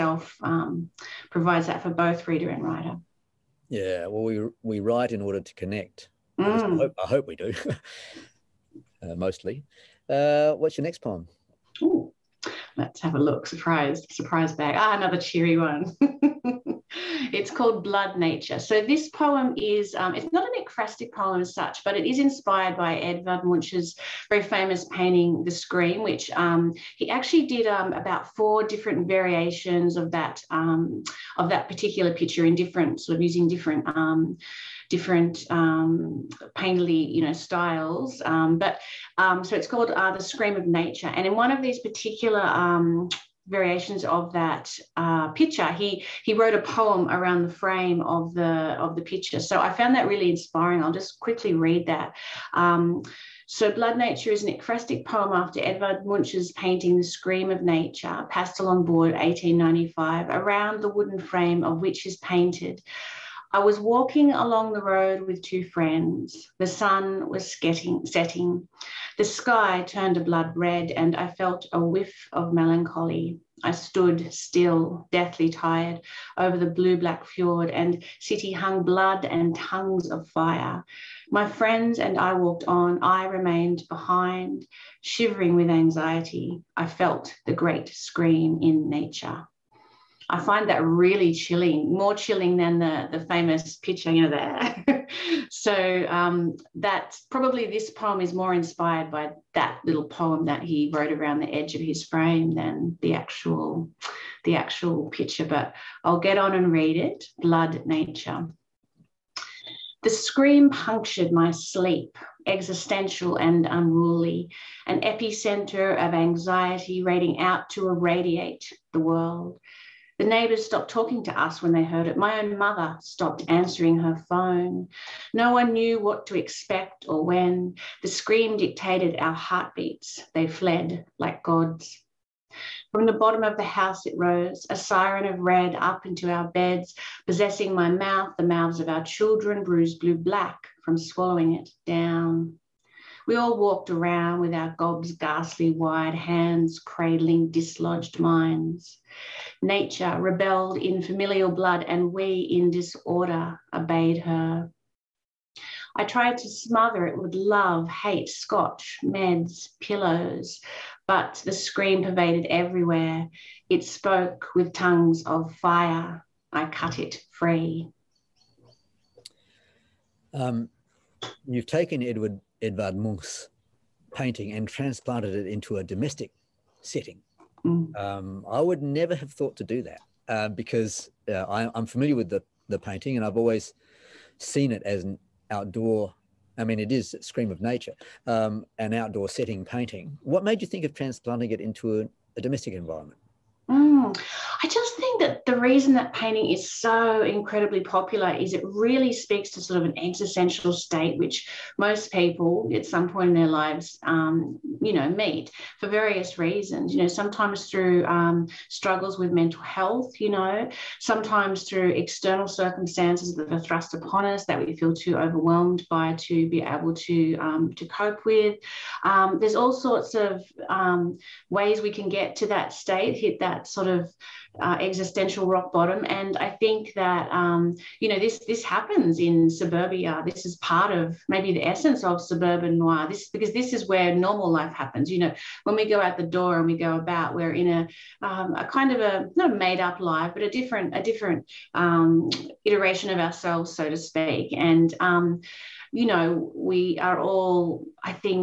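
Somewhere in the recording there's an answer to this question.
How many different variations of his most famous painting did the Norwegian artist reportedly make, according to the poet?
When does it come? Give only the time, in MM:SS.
00:27.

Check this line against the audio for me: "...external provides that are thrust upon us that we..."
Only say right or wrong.
wrong.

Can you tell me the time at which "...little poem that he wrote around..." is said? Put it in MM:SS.
01:39.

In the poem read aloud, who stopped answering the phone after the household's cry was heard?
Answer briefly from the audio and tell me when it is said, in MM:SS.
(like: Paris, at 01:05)
My own mother, at 02:02.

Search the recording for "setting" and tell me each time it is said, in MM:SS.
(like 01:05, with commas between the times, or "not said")
01:08, 02:56, 03:09.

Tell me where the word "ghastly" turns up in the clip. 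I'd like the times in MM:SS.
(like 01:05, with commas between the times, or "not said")
02:25.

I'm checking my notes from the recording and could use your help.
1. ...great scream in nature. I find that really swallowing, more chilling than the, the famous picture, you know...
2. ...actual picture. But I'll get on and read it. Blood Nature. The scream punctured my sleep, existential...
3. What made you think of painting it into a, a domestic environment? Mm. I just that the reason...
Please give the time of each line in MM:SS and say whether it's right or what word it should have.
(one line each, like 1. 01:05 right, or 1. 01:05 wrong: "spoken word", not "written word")
1. 01:27 wrong: "chilling", not "swallowing"
2. 01:44 right
3. 03:10 wrong: "transplanting", not "painting".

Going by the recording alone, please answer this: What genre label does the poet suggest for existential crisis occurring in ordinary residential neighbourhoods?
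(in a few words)
Suburban noir.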